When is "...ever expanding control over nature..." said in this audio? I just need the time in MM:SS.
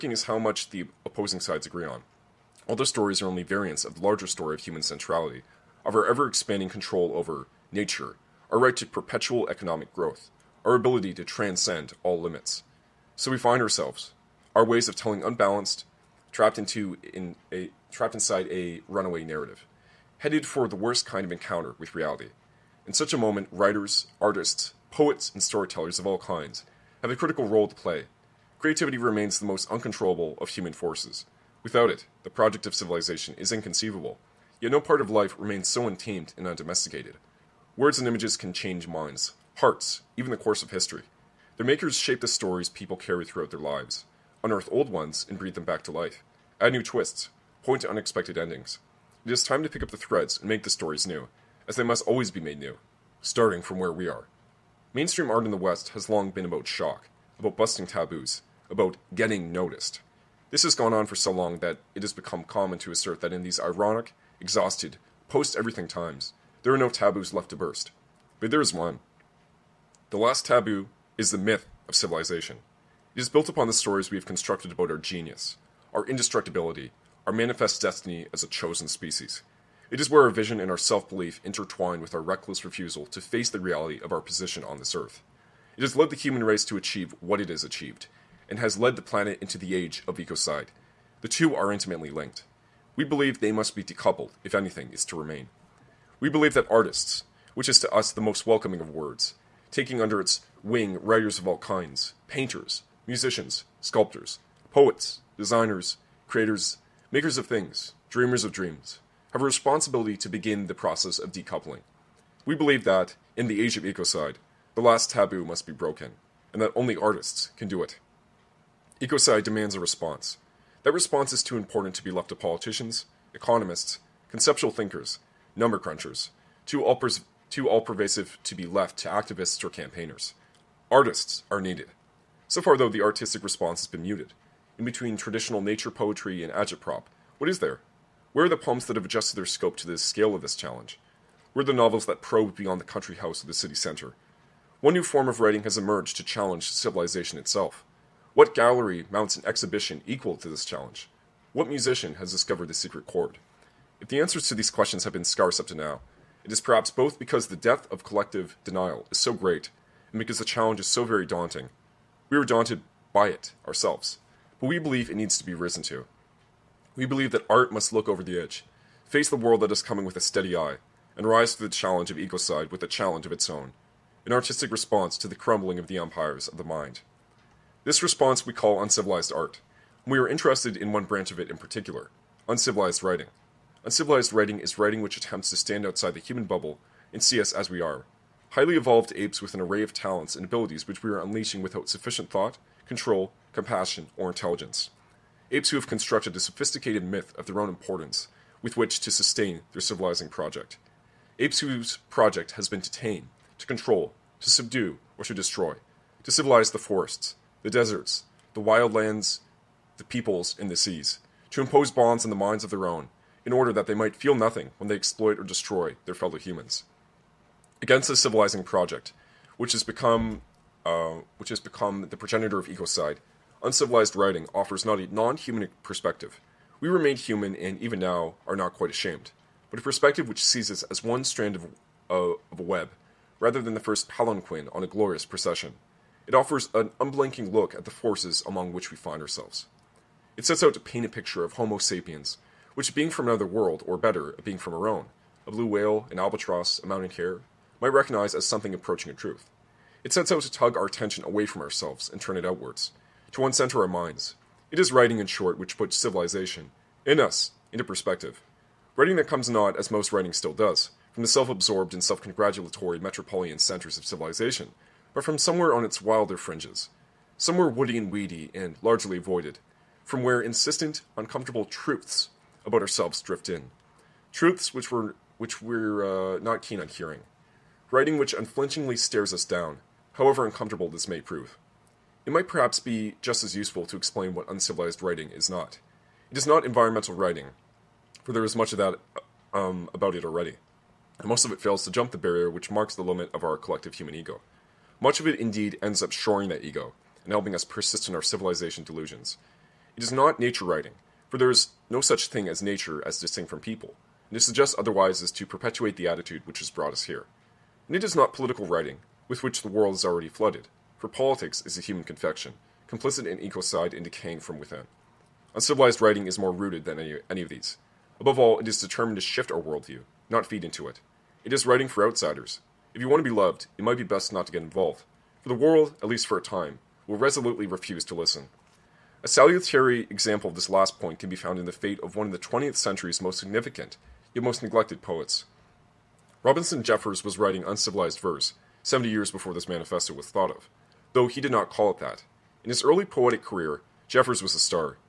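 00:06.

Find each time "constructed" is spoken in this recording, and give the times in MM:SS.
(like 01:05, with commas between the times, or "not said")
01:14, 03:15.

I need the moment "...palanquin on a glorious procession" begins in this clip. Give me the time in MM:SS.
03:54.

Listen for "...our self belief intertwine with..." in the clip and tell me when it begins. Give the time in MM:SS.
01:20.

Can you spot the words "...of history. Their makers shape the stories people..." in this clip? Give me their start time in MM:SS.
00:40.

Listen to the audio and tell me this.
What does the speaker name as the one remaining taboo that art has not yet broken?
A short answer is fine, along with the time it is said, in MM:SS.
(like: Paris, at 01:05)
The myth of civilization, at 01:11.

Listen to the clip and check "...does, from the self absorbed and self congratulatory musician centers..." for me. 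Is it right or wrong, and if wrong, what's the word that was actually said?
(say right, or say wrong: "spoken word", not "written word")
wrong: "metropolitan", not "musician".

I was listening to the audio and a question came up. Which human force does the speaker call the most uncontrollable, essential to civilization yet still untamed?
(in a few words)
Creativity.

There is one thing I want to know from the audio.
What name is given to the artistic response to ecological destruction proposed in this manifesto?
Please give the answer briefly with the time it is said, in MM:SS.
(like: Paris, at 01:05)
Uncivilized art, at 02:58.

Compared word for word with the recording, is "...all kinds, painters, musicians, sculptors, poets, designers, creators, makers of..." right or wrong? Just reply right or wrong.
right.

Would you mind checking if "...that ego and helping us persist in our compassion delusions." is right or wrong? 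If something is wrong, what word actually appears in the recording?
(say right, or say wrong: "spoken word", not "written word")
wrong: "civilization", not "compassion".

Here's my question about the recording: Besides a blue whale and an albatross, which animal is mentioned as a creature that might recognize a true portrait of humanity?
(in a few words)
Mountain hare.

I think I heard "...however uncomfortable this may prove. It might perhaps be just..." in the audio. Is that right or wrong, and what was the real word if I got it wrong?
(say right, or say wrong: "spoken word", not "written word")
right.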